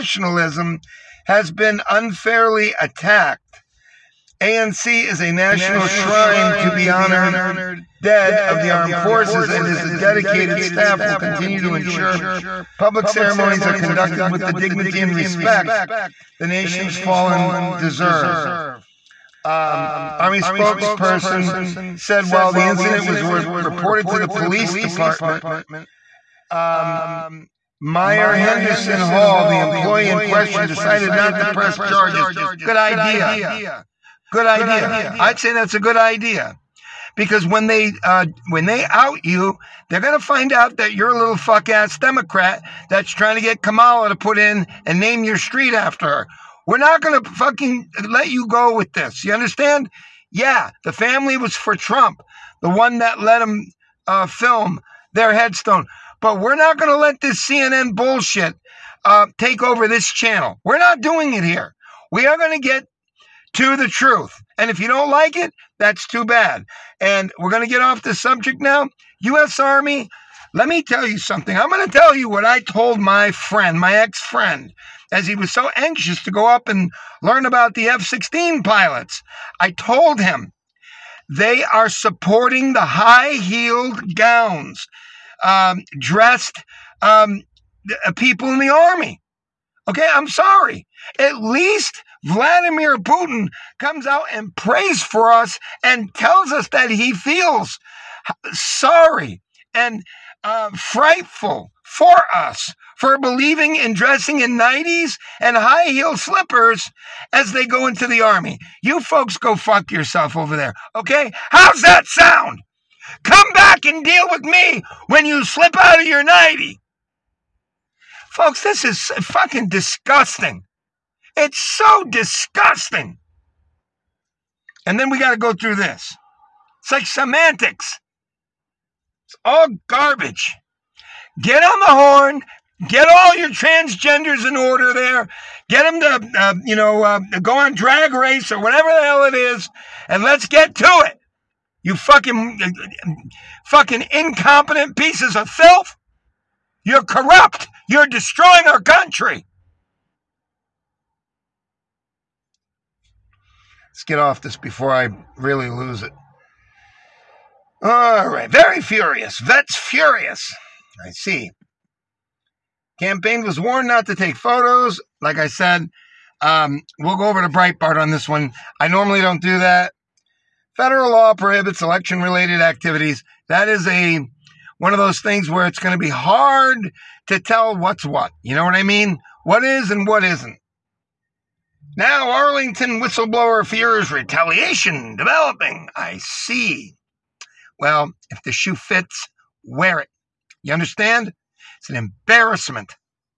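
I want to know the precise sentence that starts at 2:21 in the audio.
You fucking, fucking incompetent pieces of filth.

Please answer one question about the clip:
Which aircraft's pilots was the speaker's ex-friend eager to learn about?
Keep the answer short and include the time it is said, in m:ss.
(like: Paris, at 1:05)
F-16, at 1:17.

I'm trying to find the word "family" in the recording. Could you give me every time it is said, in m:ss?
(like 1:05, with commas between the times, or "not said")
0:50.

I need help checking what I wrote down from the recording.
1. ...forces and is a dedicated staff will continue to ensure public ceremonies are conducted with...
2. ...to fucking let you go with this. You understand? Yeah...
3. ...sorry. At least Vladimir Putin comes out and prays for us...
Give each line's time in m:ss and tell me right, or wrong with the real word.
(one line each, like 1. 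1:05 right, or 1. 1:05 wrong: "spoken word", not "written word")
1. 0:08 right
2. 0:47 right
3. 1:30 right.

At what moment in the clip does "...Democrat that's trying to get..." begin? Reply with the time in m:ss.
0:41.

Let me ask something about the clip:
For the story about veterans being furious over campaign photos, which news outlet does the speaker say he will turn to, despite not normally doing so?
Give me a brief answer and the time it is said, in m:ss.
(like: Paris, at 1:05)
Breitbart, at 2:47.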